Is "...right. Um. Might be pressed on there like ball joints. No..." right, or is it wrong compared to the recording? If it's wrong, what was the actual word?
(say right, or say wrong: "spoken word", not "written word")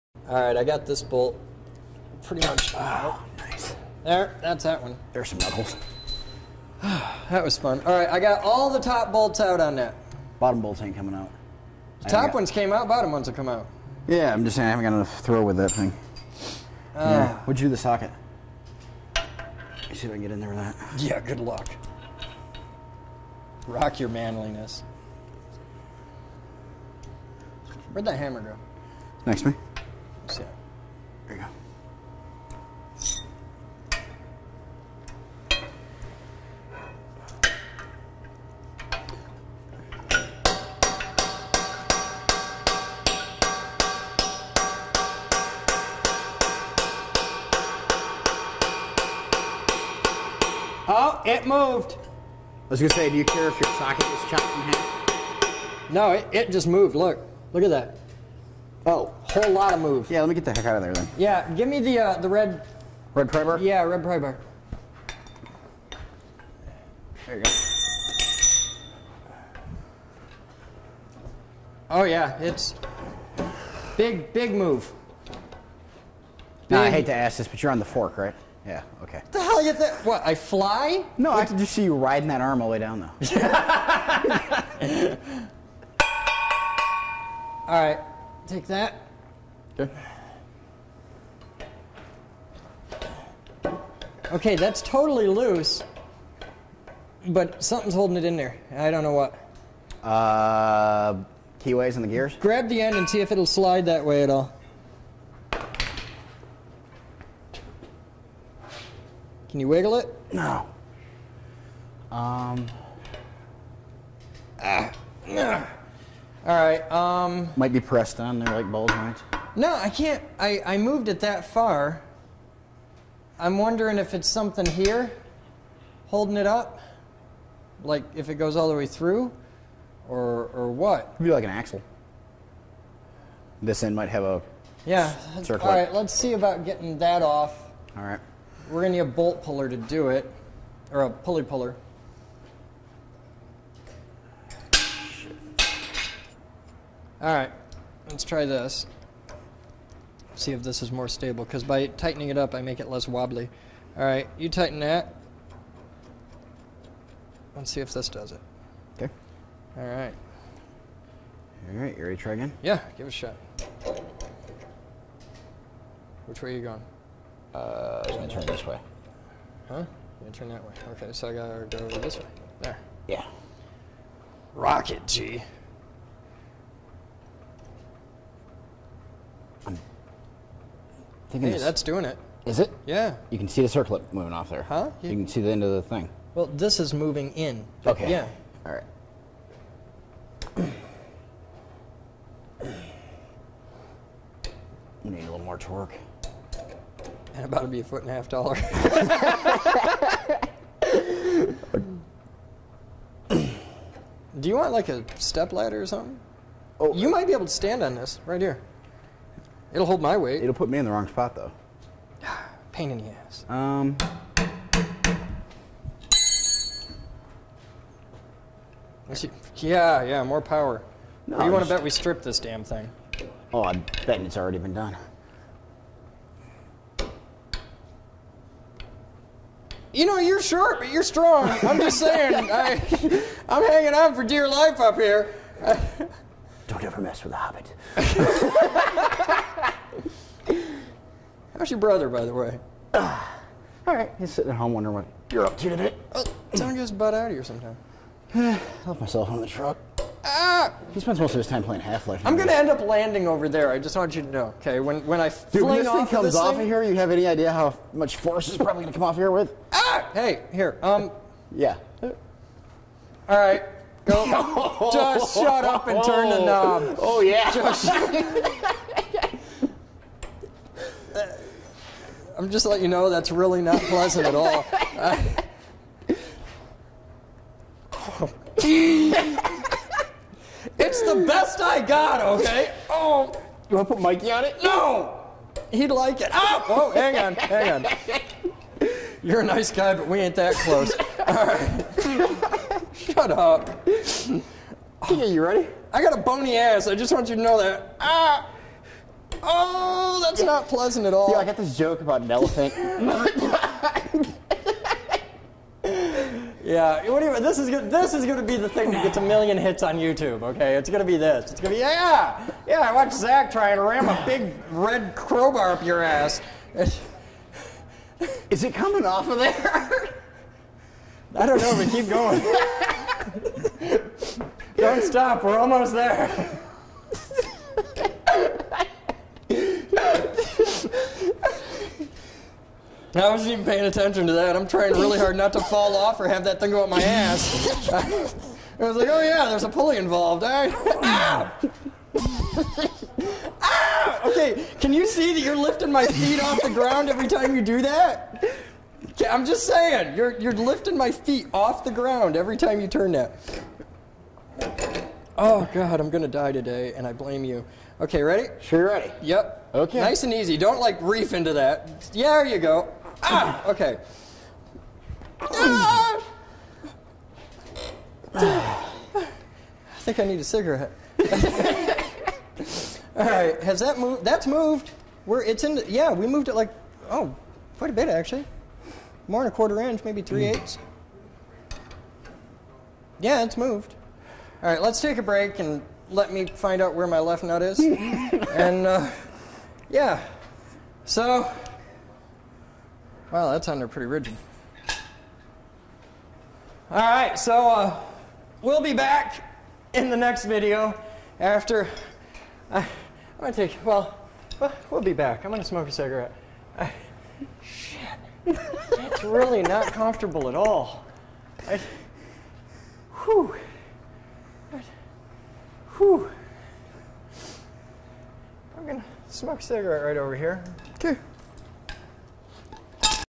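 right.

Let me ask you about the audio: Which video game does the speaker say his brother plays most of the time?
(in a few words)
Half-Life.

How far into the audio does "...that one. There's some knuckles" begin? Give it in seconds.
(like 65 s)
4 s.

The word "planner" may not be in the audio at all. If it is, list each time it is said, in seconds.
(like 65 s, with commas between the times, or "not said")
not said.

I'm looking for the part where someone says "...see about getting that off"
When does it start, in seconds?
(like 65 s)
136 s.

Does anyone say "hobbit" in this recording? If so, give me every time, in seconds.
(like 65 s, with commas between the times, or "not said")
237 s.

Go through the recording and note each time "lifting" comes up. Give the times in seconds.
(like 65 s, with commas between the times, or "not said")
345 s, 350 s.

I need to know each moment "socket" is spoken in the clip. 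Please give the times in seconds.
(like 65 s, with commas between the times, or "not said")
17 s, 53 s.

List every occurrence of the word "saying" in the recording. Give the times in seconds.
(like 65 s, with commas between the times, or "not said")
14 s, 231 s, 349 s.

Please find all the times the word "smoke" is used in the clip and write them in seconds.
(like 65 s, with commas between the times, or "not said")
405 s, 419 s.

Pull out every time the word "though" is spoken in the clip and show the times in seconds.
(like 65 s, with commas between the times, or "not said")
83 s, 211 s.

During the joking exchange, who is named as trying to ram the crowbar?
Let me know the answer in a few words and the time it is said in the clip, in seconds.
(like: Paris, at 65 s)
Zach, at 313 s.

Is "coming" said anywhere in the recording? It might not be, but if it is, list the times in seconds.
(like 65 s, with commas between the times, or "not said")
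10 s, 318 s.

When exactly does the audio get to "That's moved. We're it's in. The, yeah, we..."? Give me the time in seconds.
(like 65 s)
374 s.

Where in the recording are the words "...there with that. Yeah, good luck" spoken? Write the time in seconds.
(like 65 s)
20 s.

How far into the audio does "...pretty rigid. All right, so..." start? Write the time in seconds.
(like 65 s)
393 s.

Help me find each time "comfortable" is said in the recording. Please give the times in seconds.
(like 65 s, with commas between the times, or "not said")
409 s.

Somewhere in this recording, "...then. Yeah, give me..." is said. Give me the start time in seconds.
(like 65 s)
60 s.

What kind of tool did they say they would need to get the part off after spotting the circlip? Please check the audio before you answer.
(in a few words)
Pulley puller.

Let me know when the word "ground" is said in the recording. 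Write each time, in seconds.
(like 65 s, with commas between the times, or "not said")
346 s, 351 s.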